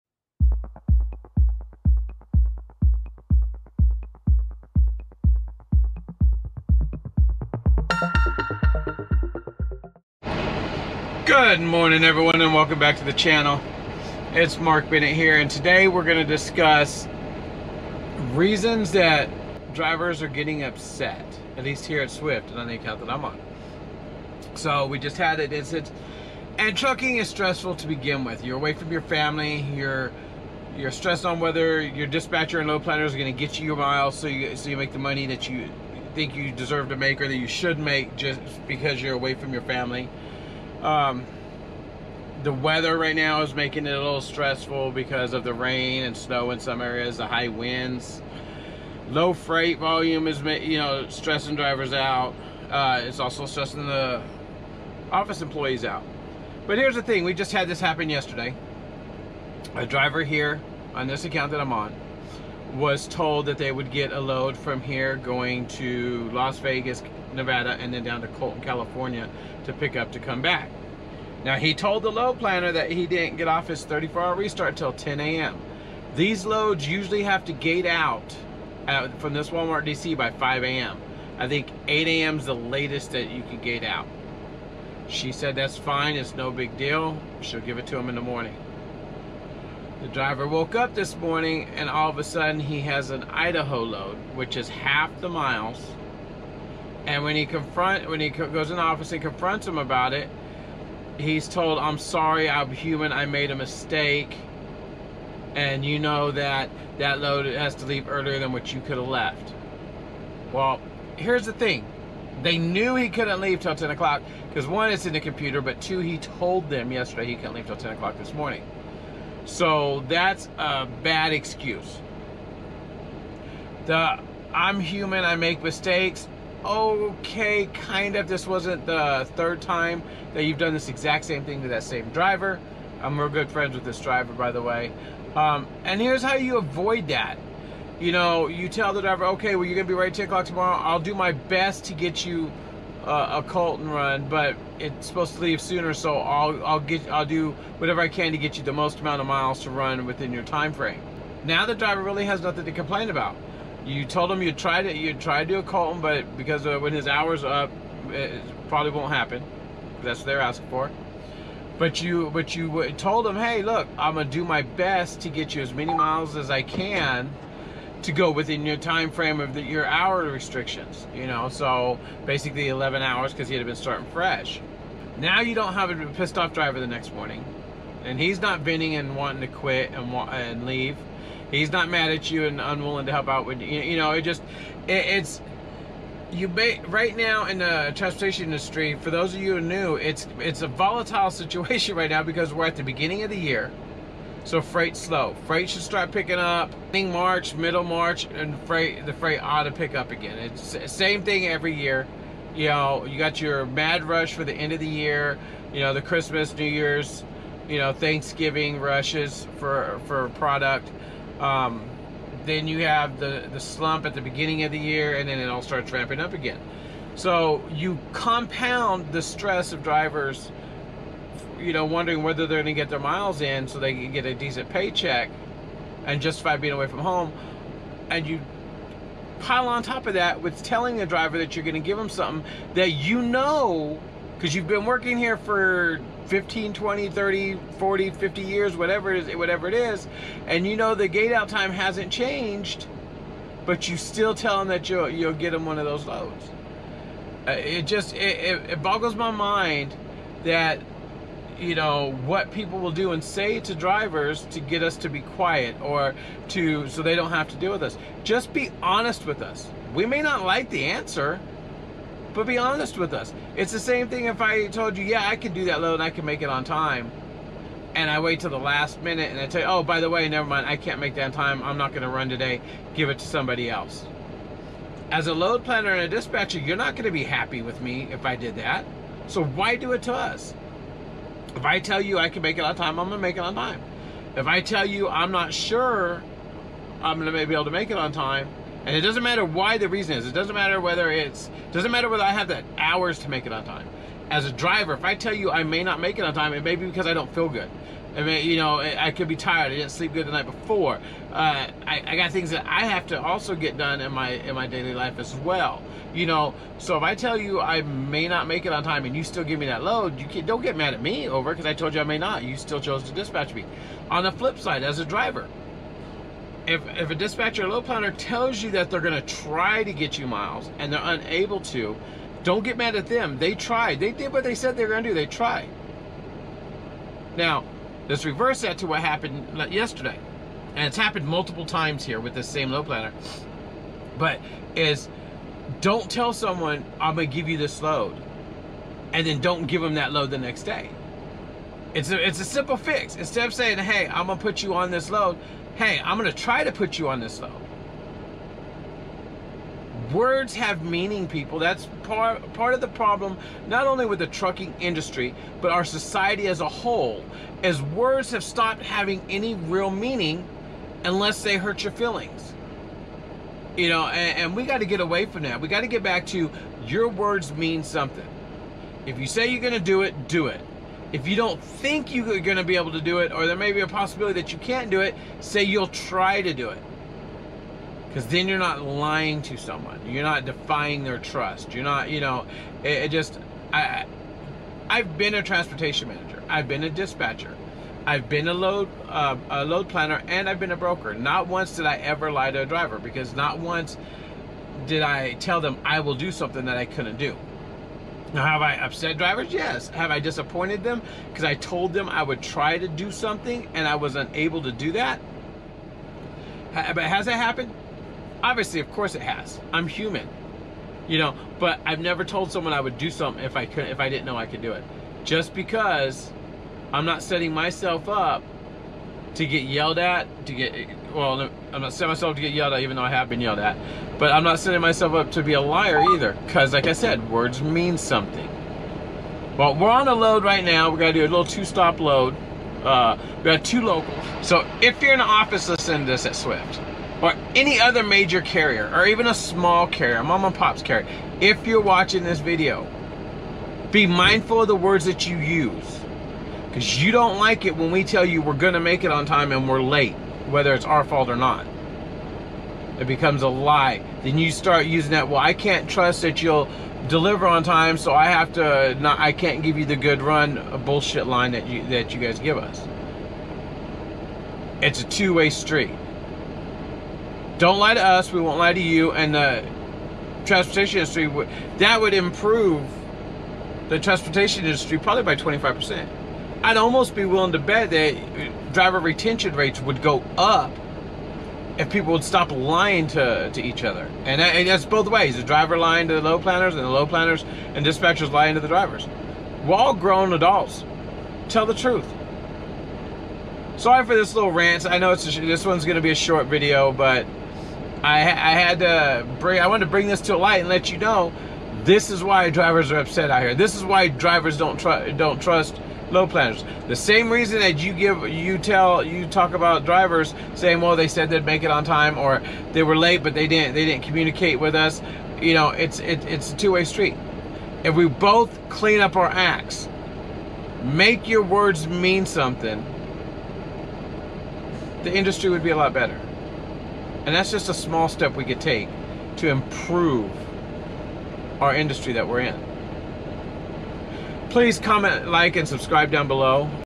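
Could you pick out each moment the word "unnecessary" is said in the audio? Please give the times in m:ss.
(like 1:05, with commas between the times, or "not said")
not said.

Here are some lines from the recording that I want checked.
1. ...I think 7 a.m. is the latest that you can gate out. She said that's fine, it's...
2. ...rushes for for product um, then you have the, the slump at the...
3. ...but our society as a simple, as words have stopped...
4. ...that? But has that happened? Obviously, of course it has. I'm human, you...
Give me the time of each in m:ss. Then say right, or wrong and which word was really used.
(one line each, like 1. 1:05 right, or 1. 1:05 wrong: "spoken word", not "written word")
1. 1:21 wrong: "8", not "7"
2. 3:28 right
3. 5:55 wrong: "whole", not "simple"
4. 6:44 right.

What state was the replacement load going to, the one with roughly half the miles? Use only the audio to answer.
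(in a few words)
Idaho.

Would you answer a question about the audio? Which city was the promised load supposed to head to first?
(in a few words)
Las Vegas, Nevada.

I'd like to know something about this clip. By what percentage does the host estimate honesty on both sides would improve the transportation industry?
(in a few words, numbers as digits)
25%.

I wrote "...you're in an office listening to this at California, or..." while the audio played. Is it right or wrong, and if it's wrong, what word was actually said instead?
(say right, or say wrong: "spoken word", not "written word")
wrong: "Swift", not "California".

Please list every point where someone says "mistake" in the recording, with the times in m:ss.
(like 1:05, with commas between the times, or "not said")
1:43, 2:05.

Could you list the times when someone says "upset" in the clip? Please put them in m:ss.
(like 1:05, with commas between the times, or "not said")
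0:20, 6:38, 8:22.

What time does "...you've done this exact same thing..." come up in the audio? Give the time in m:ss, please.
2:10.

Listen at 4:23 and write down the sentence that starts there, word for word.
It's the same thing if I told you, yeah, I can do that load and I can make it on time.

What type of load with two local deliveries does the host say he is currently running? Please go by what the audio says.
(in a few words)
Two stop load.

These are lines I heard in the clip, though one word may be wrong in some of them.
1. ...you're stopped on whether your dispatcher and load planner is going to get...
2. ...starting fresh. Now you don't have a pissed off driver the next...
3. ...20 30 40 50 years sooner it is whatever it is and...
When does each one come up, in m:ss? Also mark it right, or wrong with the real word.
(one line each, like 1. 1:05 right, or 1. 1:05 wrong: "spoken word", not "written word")
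1. 0:30 wrong: "stressed", not "stopped"
2. 2:53 right
3. 3:56 wrong: "whatever", not "sooner".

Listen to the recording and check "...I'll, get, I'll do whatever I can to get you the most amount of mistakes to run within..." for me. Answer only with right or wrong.
wrong.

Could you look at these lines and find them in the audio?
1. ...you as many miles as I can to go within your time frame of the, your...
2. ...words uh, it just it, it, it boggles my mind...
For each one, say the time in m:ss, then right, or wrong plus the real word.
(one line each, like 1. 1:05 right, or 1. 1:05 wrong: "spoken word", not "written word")
1. 2:45 right
2. 4:06 wrong: "loads", not "words".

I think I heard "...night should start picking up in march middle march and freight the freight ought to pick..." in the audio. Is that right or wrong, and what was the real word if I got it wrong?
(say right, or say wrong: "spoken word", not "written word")
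wrong: "freight", not "night".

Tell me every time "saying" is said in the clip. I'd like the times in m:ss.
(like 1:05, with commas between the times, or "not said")
5:43, 8:30.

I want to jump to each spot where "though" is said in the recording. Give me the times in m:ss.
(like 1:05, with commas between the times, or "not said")
5:47, 7:02.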